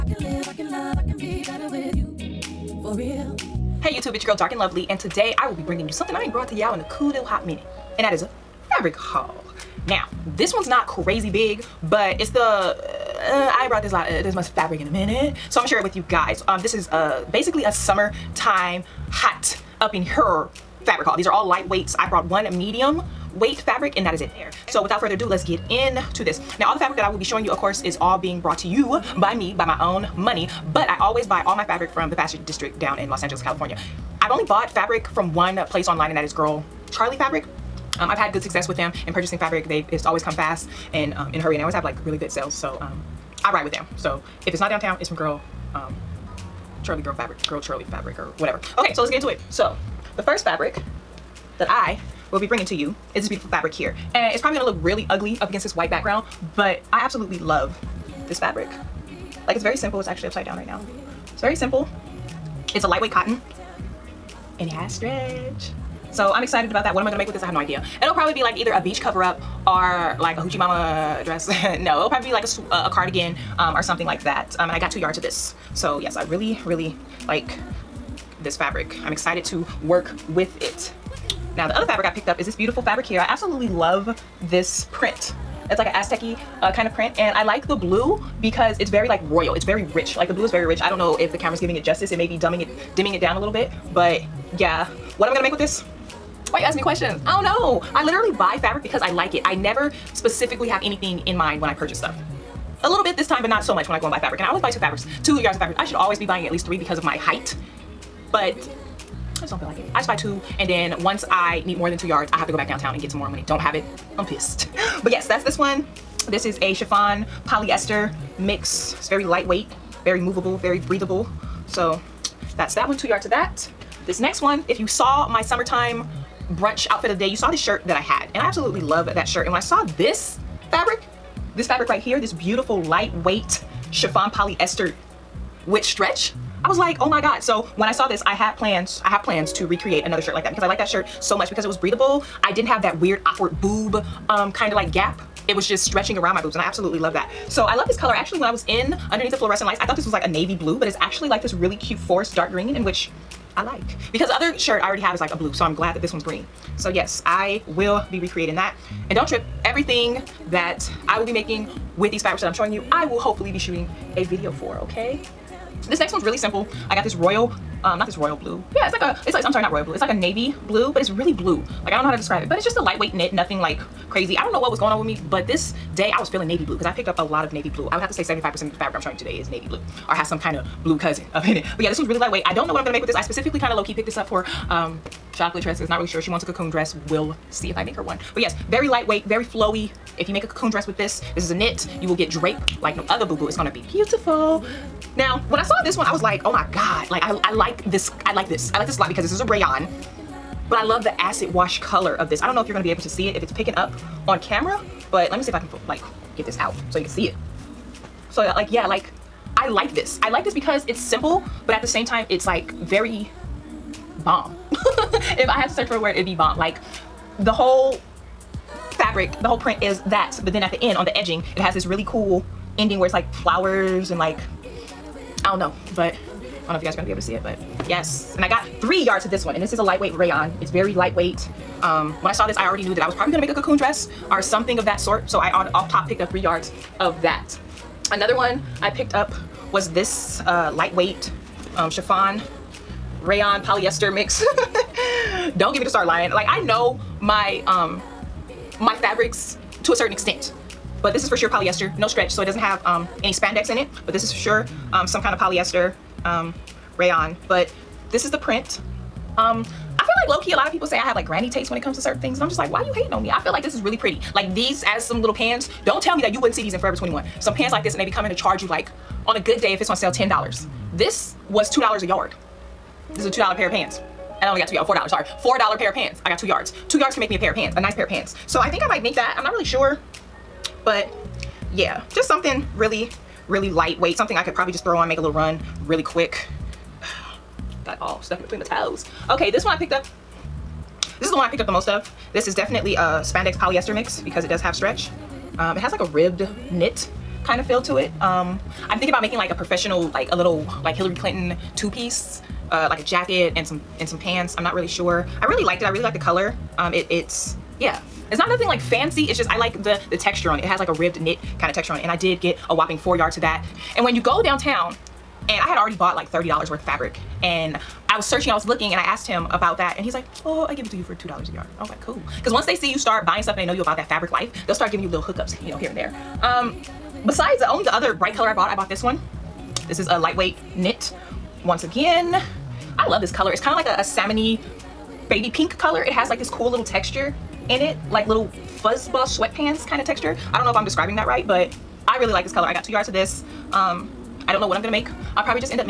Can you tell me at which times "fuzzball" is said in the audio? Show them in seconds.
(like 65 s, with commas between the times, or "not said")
338 s.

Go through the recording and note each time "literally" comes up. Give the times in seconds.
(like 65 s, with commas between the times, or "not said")
98 s.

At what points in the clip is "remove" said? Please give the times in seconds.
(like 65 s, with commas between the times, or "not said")
not said.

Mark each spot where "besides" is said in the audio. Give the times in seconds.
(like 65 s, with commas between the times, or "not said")
327 s.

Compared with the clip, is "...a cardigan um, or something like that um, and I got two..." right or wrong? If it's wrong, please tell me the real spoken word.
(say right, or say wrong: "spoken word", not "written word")
right.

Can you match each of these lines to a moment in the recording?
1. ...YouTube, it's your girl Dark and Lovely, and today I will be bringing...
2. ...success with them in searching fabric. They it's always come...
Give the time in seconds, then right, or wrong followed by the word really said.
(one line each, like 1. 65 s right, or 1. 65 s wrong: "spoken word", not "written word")
1. 3 s right
2. 38 s wrong: "purchasing", not "searching".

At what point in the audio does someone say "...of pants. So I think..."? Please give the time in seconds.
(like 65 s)
278 s.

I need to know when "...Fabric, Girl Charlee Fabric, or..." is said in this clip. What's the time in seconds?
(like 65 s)
47 s.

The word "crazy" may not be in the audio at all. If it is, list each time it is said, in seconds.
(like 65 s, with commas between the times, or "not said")
10 s, 174 s.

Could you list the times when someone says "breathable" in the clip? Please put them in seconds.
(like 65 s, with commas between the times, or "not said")
120 s, 141 s.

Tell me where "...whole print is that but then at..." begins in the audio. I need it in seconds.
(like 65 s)
219 s.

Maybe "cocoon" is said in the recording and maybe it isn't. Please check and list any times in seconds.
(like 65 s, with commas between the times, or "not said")
186 s, 190 s, 233 s.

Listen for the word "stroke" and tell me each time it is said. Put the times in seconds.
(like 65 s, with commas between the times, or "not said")
not said.